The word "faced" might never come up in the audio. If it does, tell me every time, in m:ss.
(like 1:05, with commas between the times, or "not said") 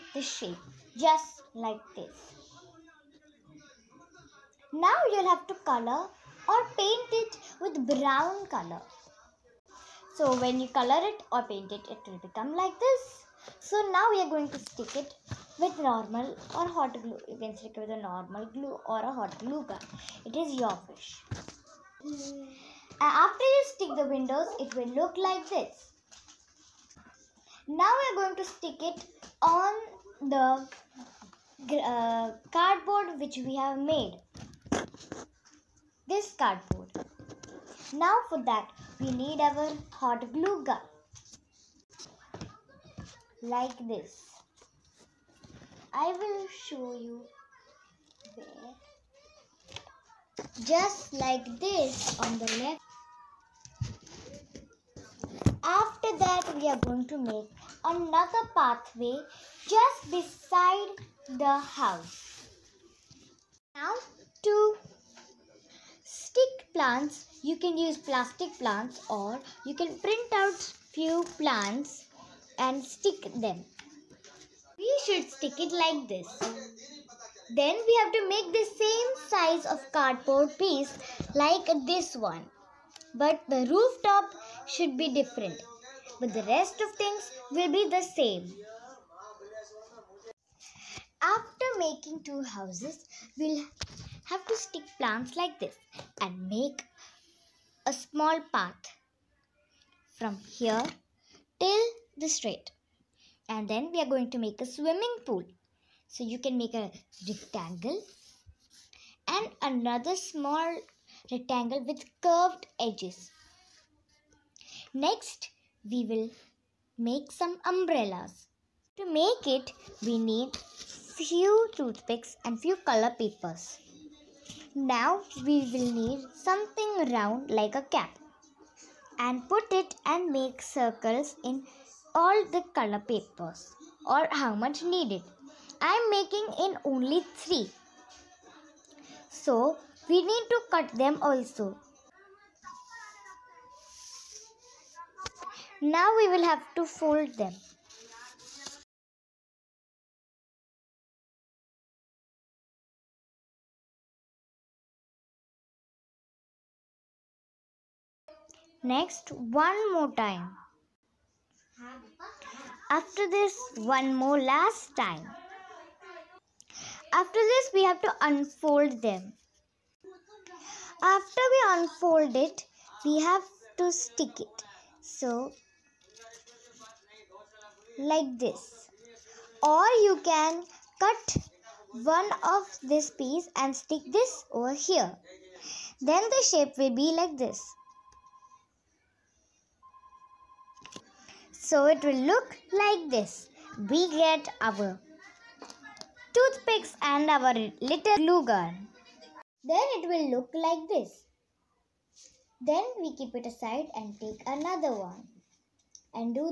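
not said.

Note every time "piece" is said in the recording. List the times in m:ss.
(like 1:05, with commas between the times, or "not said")
1:20, 3:03.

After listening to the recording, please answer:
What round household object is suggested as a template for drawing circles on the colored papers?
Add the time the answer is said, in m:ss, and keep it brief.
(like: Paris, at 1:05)
A cap, at 2:07.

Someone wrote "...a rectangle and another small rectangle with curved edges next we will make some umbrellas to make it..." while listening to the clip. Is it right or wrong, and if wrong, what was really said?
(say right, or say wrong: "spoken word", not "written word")
right.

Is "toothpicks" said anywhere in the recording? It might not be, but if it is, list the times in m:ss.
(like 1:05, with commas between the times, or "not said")
2:01, 3:16.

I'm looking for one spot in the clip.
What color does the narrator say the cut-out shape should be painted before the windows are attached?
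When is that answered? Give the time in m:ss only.
0:07.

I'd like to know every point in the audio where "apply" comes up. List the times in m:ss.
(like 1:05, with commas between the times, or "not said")
not said.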